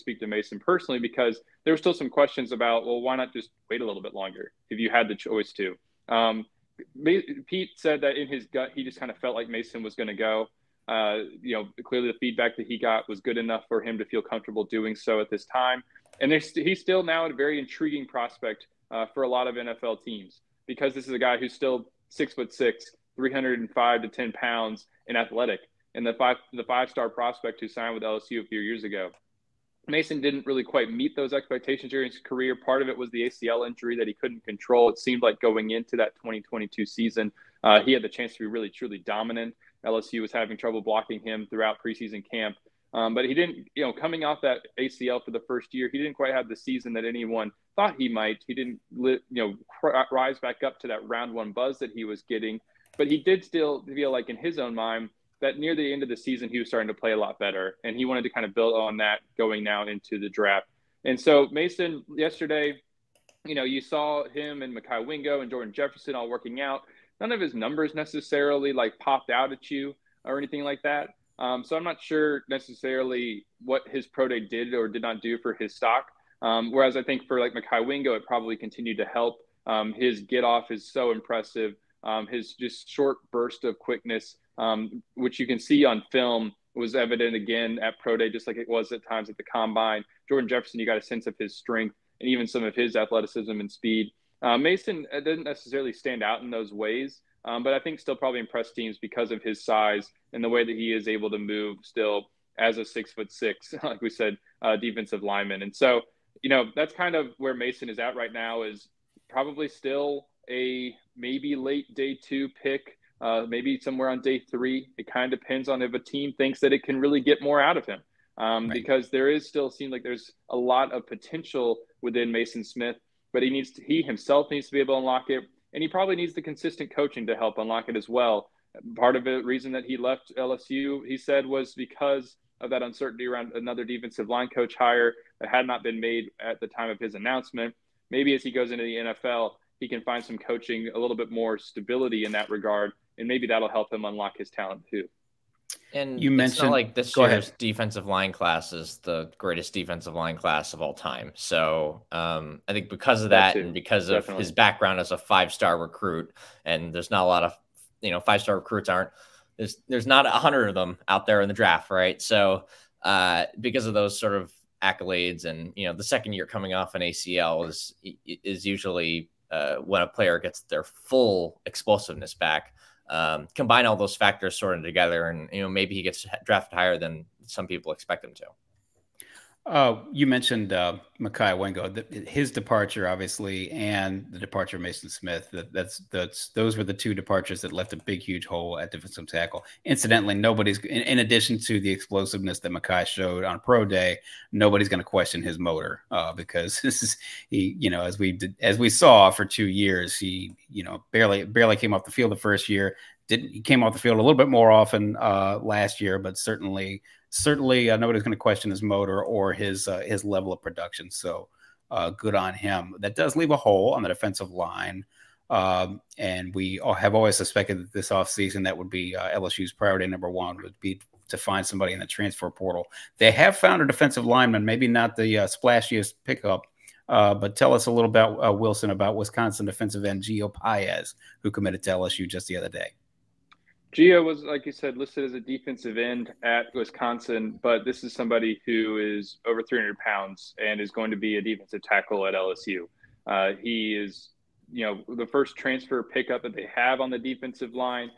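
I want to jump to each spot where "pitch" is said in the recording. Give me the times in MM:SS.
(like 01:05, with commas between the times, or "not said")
not said.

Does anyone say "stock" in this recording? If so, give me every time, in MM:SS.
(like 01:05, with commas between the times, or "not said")
01:15.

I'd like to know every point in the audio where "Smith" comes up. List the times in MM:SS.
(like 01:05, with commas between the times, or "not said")
02:02, 03:05.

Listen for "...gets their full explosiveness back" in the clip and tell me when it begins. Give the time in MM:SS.
02:50.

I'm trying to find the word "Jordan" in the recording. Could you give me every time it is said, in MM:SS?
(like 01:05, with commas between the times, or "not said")
01:05, 01:30.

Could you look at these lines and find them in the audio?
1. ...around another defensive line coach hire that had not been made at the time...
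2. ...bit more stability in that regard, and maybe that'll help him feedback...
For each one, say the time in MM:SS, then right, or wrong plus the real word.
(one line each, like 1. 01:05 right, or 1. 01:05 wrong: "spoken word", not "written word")
1. 02:13 right
2. 02:21 wrong: "unlock", not "feedback".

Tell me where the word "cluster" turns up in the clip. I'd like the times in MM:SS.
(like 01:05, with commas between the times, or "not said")
not said.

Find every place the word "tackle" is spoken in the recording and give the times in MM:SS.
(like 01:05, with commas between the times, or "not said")
03:09, 04:01.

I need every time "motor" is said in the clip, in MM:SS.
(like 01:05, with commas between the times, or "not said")
03:15, 03:28.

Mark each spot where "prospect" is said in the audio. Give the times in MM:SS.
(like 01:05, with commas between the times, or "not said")
00:18, 00:27.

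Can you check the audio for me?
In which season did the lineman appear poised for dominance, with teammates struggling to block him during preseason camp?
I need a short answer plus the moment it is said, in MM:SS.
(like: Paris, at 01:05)
2022, at 00:36.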